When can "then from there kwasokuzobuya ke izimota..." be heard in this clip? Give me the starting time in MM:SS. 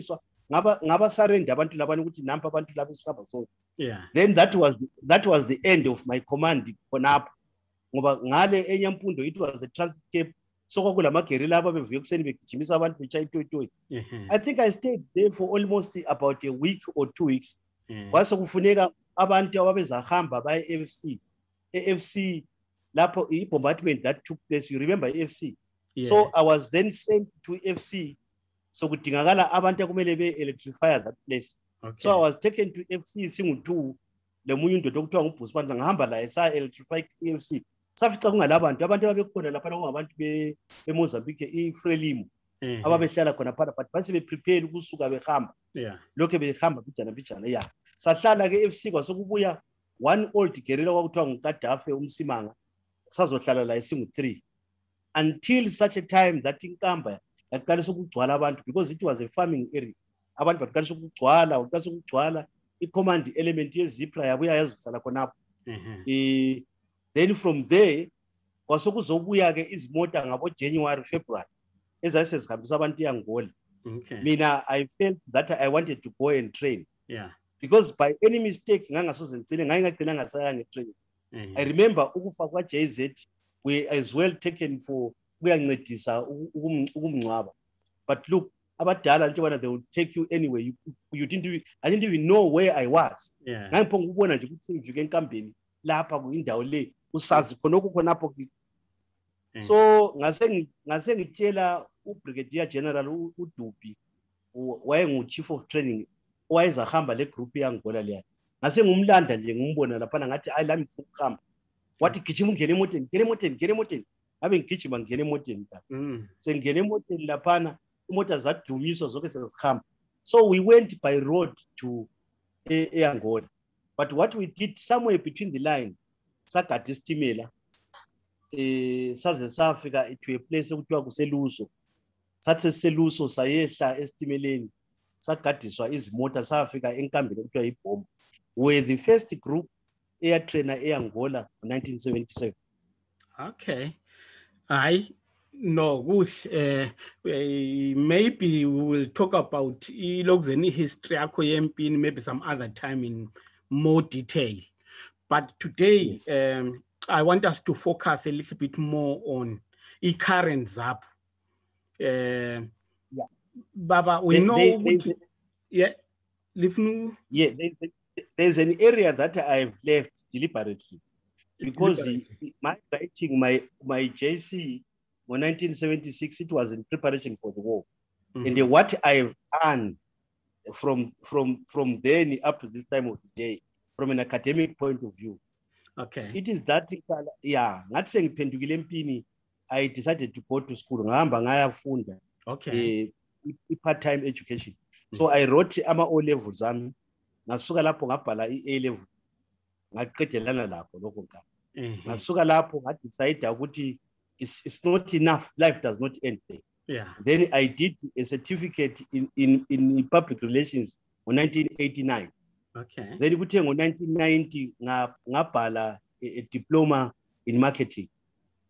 01:07.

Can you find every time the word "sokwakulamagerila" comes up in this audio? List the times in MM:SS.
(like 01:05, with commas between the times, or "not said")
00:10.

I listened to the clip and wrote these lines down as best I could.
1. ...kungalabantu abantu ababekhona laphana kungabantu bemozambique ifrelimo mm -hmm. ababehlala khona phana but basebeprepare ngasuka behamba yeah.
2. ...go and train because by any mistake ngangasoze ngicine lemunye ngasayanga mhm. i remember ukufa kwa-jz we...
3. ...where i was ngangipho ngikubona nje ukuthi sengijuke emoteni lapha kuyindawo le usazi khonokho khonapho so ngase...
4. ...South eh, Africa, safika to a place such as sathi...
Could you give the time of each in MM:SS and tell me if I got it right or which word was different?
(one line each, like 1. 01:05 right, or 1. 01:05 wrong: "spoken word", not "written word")
1. 00:38 wrong: "ukusuka", not "ngasuka"
2. 01:16 wrong: "ngaye", not "lemunye"
3. 01:32 wrong: "enkambeni", not "emoteni"
4. 02:09 right.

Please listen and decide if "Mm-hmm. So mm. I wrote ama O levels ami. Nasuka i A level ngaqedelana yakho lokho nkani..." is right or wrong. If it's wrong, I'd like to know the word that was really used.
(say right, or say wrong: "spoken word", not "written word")
wrong: "lakho", not "yakho".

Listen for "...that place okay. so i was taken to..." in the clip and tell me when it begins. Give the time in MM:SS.
00:30.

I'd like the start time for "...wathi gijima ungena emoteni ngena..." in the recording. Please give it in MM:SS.
01:51.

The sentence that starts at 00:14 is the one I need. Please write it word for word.
i think i stayed there for almost about a week or two weeks mm.